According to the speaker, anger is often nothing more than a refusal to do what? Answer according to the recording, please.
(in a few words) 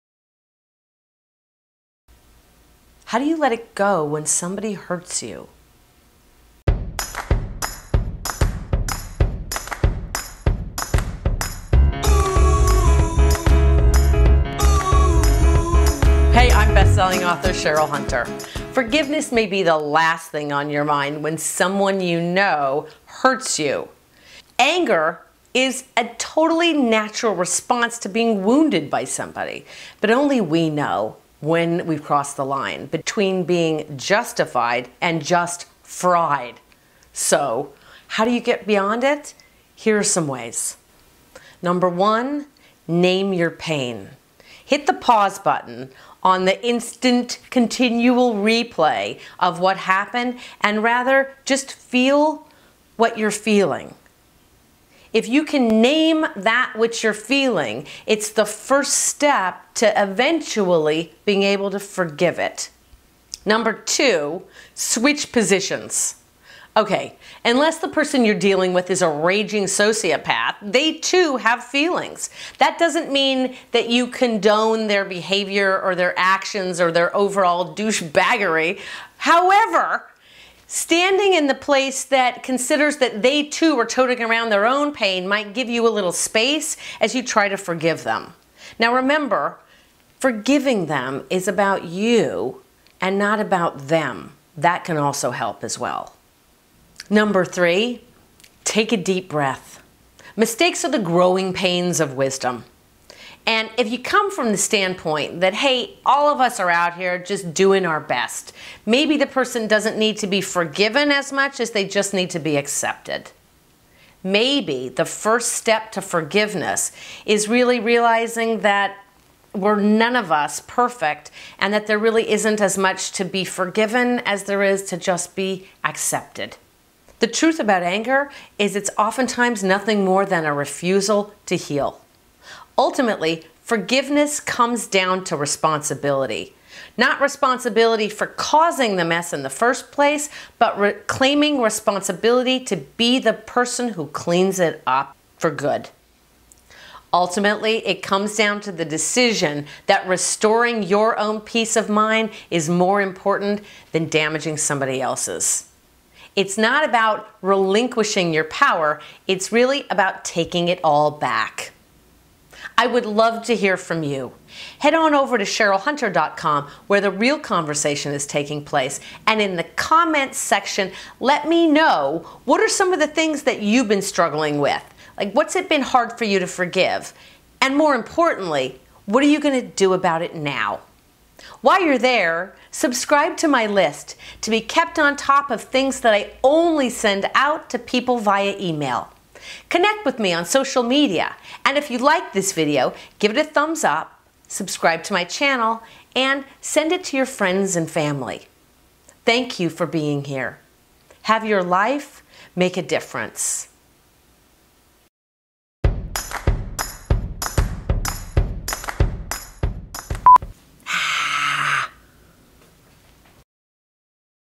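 heal.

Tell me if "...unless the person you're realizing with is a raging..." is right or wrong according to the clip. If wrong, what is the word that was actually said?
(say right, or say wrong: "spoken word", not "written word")
wrong: "dealing", not "realizing".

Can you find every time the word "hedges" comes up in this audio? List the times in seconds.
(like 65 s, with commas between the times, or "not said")
not said.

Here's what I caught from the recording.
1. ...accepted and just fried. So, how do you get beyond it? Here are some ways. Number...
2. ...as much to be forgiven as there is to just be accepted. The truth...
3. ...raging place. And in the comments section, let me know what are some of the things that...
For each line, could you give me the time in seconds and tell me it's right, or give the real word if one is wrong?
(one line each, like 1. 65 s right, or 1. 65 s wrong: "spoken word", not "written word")
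1. 33 s wrong: "justified", not "accepted"
2. 122 s right
3. 168 s wrong: "taking", not "raging".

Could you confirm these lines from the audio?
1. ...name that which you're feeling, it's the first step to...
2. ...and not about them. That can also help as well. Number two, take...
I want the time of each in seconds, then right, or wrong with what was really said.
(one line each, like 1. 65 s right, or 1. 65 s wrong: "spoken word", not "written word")
1. 55 s right
2. 93 s wrong: "three", not "two".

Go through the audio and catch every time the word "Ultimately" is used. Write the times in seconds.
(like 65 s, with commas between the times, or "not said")
132 s, 147 s.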